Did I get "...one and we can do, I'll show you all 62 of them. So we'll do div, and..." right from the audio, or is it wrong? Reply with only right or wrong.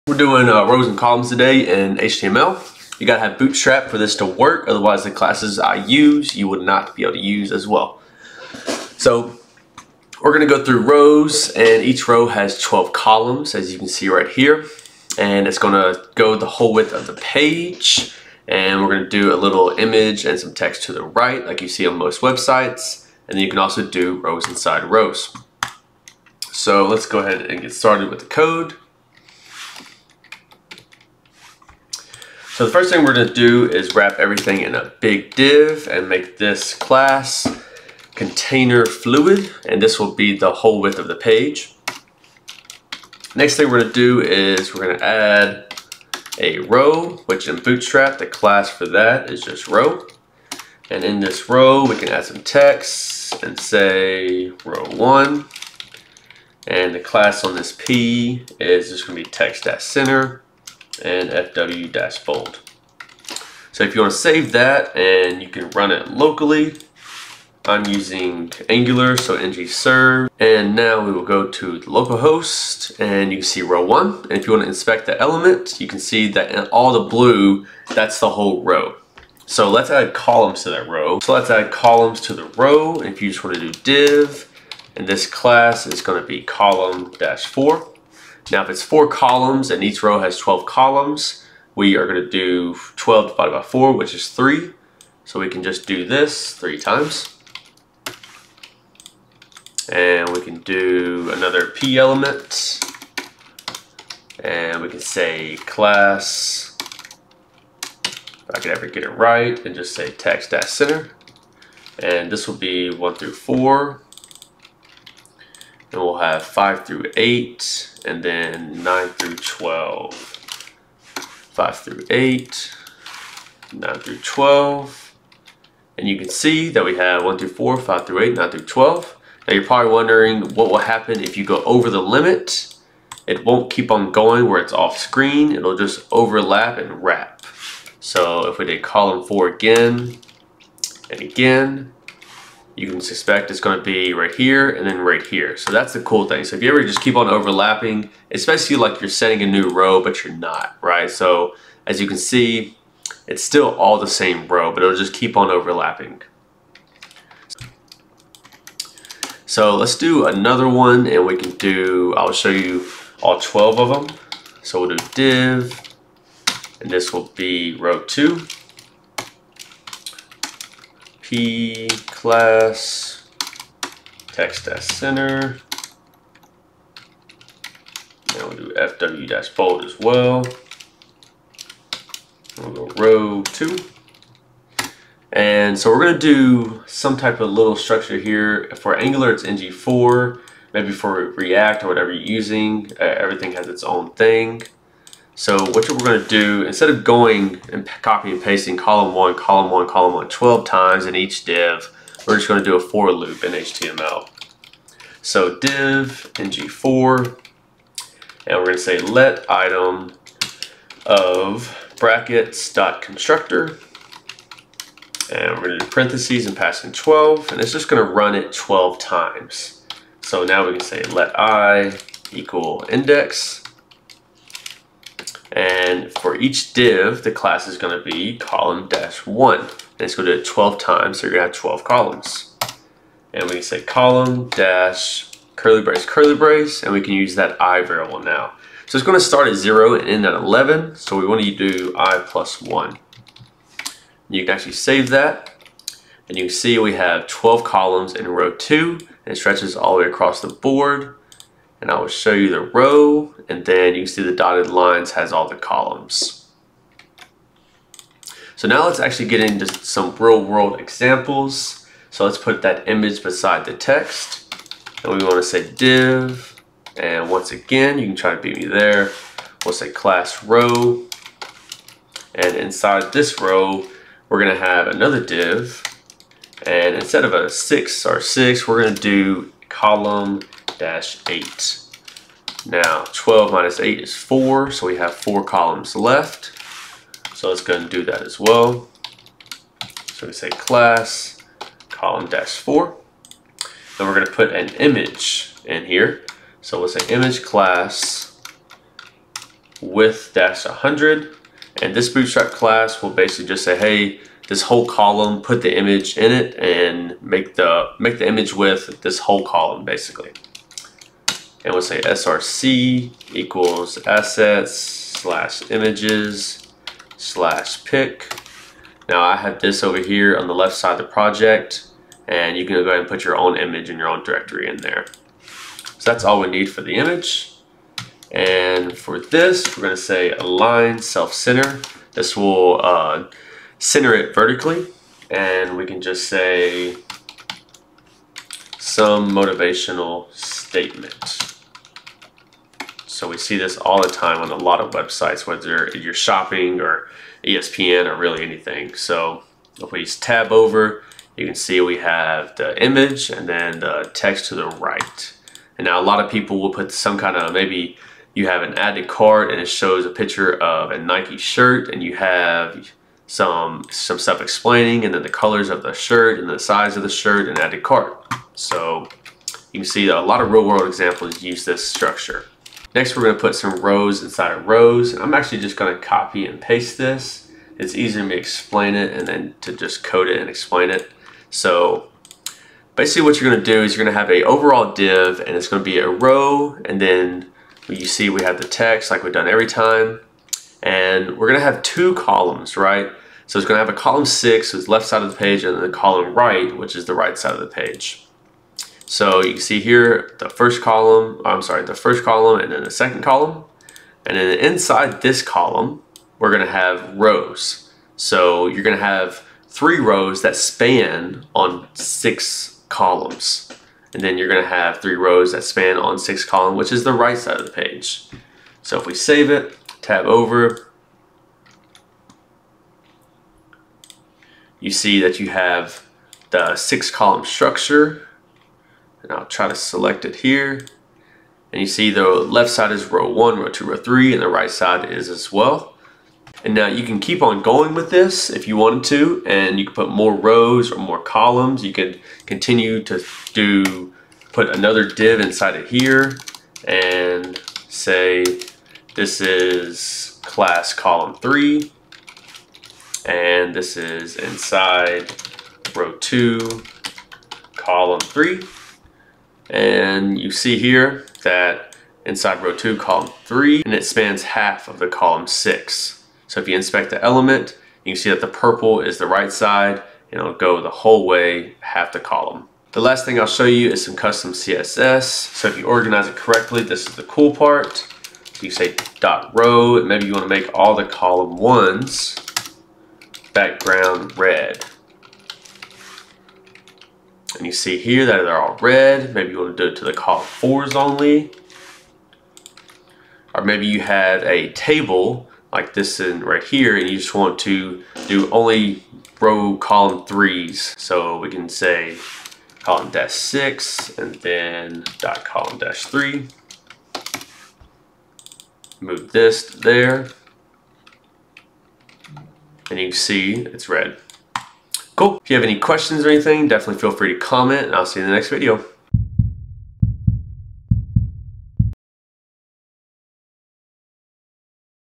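wrong.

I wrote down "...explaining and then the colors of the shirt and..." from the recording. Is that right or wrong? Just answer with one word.
right.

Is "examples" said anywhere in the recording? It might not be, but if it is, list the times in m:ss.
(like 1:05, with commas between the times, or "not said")
4:20, 6:10.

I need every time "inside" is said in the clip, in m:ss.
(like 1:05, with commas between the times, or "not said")
0:24, 4:32, 6:14, 6:44, 7:25, 7:34, 7:42.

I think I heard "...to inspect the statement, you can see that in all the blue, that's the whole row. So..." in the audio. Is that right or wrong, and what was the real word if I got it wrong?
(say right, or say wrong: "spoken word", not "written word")
wrong: "element", not "statement".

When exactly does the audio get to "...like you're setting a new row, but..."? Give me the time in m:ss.
2:28.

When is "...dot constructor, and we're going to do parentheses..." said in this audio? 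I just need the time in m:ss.
3:32.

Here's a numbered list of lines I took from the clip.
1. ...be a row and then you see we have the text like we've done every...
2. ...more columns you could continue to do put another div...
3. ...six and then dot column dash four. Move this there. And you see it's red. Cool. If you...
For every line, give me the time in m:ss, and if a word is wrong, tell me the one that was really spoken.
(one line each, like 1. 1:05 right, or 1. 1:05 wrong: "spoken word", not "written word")
1. 6:25 right
2. 7:20 right
3. 8:23 wrong: "three", not "four".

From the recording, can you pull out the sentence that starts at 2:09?
Now you're probably wondering what will happen if you go over the limit.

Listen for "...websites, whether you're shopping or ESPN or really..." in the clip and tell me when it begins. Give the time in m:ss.
5:44.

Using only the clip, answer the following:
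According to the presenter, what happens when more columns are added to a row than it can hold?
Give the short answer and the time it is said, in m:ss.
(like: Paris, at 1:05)
overlap and wrap, at 2:16.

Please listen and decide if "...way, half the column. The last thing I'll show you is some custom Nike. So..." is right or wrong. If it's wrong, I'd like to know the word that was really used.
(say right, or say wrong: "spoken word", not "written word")
wrong: "CSS", not "Nike".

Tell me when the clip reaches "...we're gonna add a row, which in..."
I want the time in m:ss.
0:44.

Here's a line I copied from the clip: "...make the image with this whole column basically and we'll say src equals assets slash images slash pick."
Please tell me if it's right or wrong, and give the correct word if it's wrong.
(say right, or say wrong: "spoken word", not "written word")
right.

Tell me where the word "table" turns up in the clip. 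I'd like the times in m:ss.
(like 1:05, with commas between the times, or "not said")
8:14.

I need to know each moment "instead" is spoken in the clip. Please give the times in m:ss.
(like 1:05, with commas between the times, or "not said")
3:16, 4:36.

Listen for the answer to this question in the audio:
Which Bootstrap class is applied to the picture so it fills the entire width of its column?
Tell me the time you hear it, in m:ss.
4:59.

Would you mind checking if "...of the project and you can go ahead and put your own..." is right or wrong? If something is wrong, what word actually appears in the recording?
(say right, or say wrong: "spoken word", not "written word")
right.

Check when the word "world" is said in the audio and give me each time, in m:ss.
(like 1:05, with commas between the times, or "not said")
4:20, 6:10.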